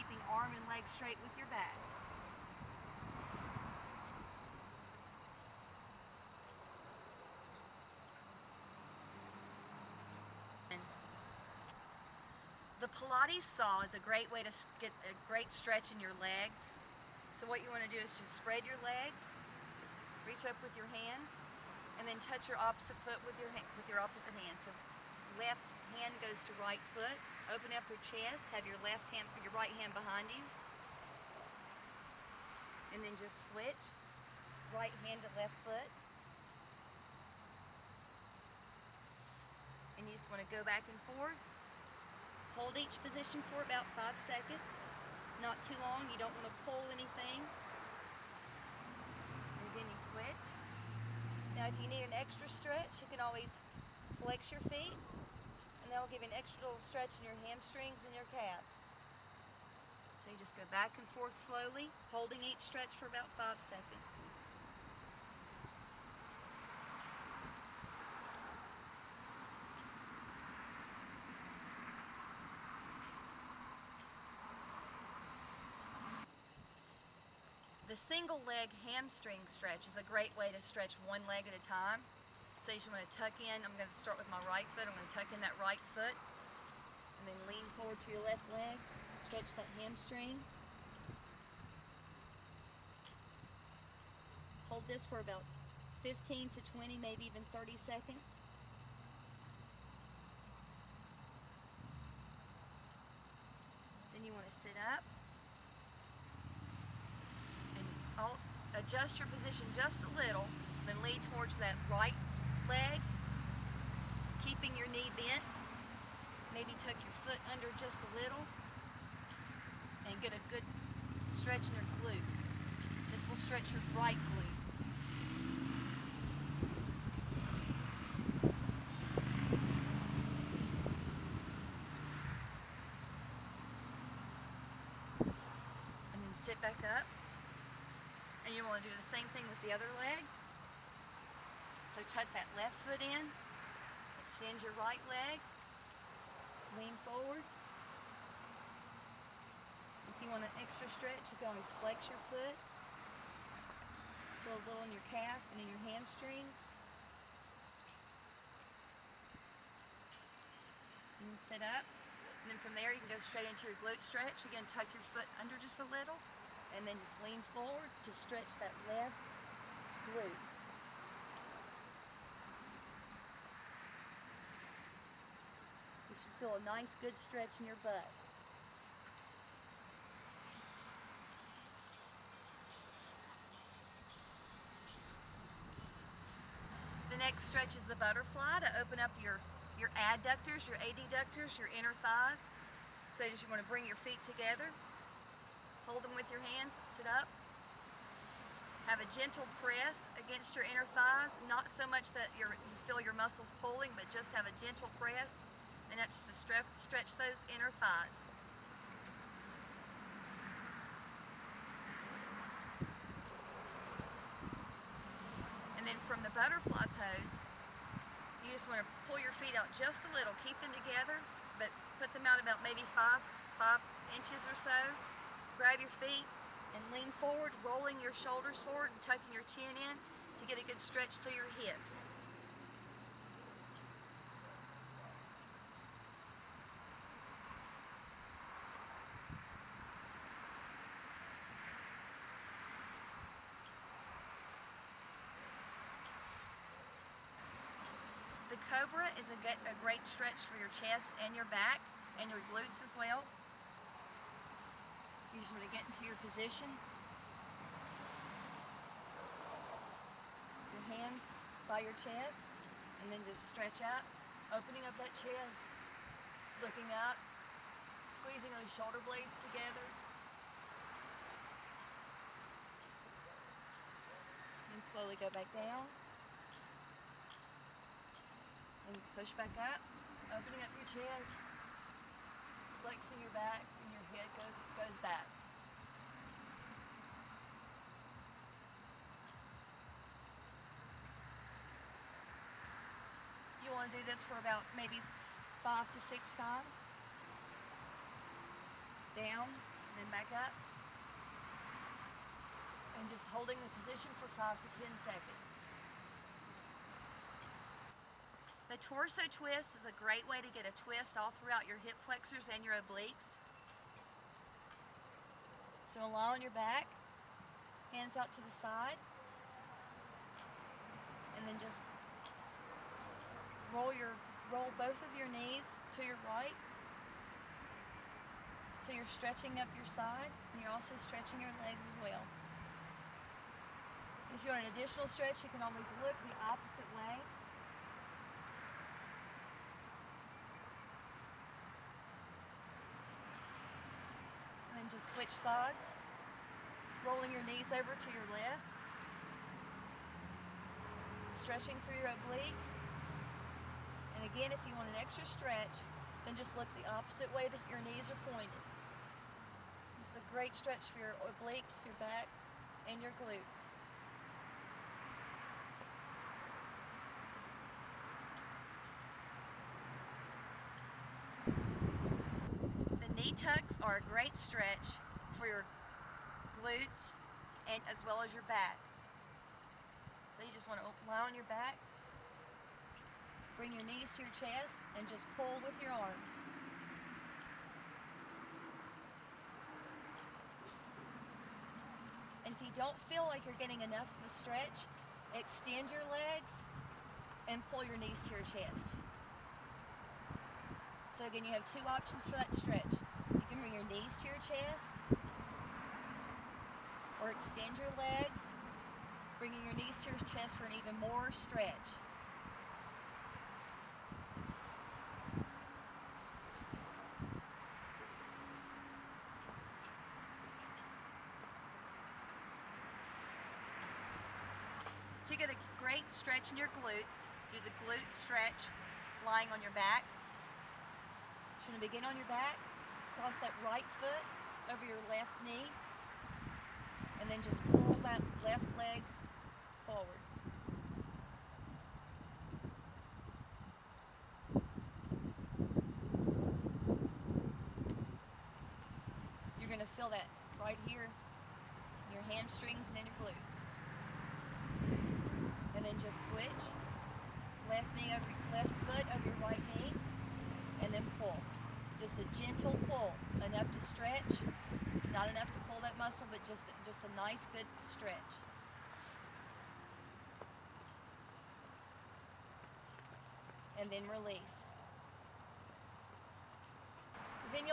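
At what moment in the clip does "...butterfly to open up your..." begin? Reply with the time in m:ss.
3:07.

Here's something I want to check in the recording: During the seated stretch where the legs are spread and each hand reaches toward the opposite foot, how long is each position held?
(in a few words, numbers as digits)
5 seconds.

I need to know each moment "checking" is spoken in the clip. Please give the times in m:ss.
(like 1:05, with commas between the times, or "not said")
not said.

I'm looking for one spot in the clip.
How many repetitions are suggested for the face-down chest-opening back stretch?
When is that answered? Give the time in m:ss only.
4:55.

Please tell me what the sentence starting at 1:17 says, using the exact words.
The single leg hamstring stretch is a great way to stretch one leg at a time.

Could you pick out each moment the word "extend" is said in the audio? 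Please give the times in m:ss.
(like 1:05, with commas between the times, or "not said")
2:24, 6:35, 6:47.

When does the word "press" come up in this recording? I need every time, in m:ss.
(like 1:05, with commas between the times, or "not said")
3:19, 3:24.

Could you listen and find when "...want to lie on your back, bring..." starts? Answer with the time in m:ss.
6:20.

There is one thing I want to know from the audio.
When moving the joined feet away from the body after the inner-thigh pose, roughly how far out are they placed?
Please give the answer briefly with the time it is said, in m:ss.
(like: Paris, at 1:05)
5 inches, at 3:43.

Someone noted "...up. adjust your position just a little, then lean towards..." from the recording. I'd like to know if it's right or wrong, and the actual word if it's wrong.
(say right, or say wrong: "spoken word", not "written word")
right.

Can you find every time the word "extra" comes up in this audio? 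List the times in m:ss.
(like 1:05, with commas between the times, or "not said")
0:52, 0:56, 2:30, 5:55.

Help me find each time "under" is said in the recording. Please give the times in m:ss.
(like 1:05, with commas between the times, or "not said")
1:57, 2:45.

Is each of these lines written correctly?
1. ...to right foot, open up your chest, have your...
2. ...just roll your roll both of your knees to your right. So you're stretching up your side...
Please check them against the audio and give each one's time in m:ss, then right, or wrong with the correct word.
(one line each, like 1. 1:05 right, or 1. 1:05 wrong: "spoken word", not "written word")
1. 0:26 right
2. 5:21 right.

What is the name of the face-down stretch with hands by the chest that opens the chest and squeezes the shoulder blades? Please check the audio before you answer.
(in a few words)
The Cobra.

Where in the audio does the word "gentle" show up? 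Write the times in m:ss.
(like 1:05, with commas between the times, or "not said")
3:19, 3:24, 7:42.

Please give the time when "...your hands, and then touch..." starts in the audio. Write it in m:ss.
0:20.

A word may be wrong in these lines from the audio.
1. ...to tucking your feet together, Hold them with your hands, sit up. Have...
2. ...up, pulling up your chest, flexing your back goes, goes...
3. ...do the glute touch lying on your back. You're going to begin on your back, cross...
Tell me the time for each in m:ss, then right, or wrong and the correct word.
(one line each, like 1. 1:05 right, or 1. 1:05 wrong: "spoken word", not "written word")
1. 3:13 wrong: "bring", not "tucking"
2. 4:39 wrong: "opening", not "pulling"
3. 7:07 wrong: "stretch", not "touch".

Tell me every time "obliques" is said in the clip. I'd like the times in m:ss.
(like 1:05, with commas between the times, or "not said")
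5:12, 5:52, 6:01.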